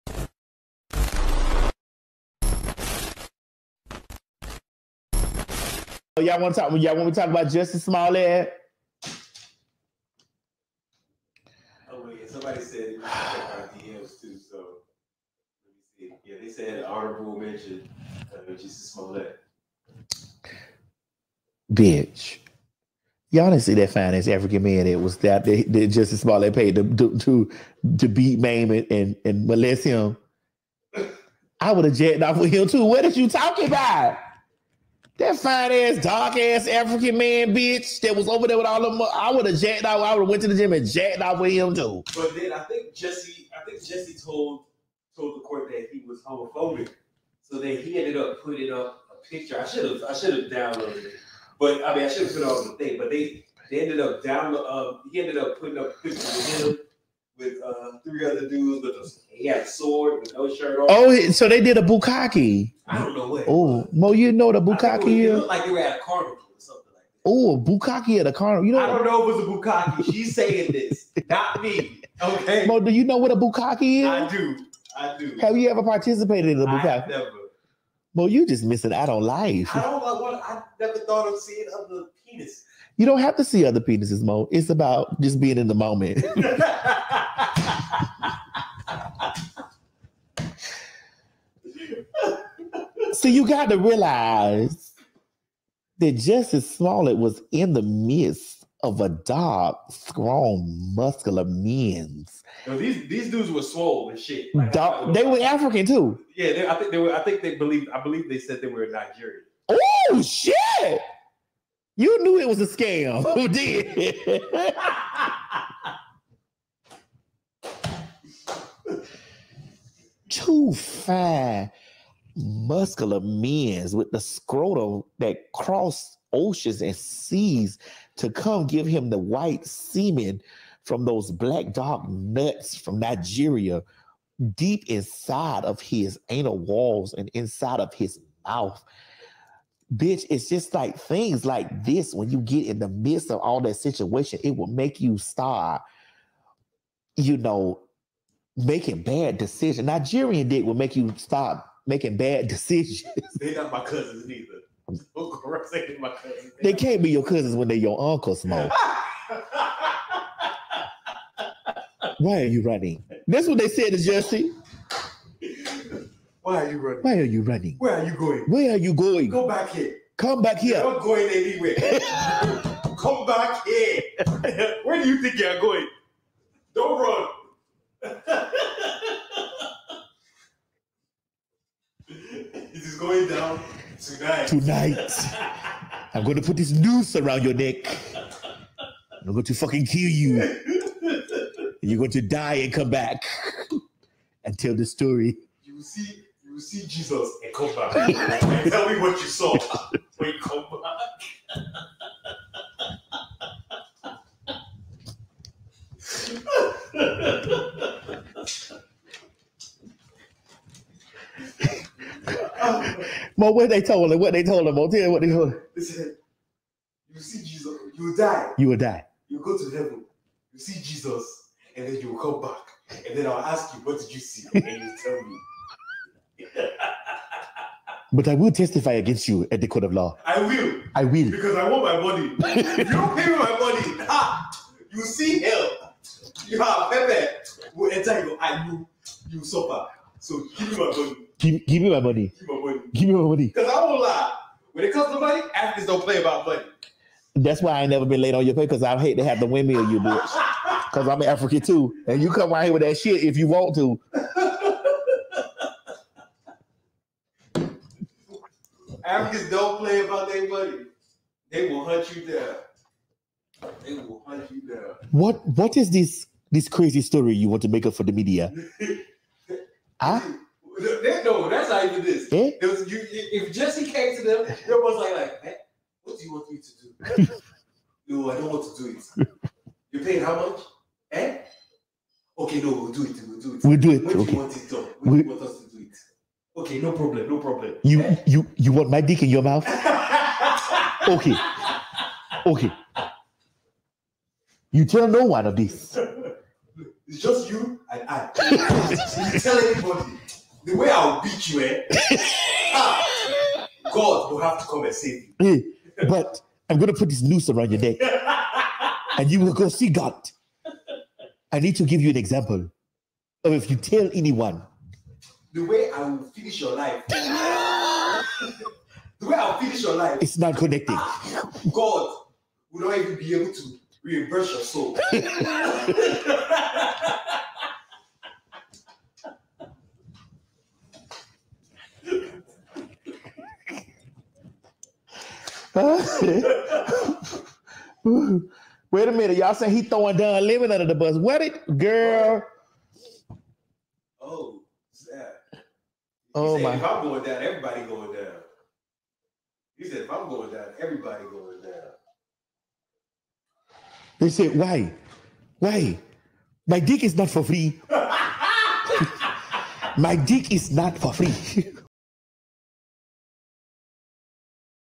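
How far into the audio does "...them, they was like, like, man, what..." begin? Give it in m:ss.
4:34.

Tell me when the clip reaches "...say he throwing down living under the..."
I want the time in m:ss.
5:39.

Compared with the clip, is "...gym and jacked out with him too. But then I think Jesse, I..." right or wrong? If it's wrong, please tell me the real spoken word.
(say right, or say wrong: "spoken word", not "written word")
right.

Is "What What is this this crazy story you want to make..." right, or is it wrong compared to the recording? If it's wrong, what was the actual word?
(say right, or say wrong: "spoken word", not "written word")
right.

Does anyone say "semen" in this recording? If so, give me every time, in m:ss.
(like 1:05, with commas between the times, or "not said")
2:09.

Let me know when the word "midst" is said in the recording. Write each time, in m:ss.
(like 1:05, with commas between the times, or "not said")
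1:37, 2:22.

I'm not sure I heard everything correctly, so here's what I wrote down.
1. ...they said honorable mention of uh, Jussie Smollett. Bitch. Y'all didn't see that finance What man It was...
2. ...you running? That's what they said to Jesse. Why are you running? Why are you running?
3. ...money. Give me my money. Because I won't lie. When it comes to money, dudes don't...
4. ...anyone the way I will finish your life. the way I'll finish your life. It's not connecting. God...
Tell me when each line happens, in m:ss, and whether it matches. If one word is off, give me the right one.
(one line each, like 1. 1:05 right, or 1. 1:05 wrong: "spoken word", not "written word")
1. 0:16 wrong: "African", not "What"
2. 2:42 right
3. 4:02 wrong: "athletes", not "dudes"
4. 5:14 right.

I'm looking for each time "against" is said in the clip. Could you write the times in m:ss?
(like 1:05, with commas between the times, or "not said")
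3:48.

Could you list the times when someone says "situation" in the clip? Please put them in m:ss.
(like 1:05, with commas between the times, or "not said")
2:23.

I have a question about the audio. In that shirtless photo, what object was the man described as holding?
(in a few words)
A sword.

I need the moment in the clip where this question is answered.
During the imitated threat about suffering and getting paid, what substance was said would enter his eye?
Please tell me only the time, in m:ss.
3:56.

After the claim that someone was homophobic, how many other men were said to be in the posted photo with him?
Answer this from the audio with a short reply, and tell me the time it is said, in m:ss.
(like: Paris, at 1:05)
3, at 0:58.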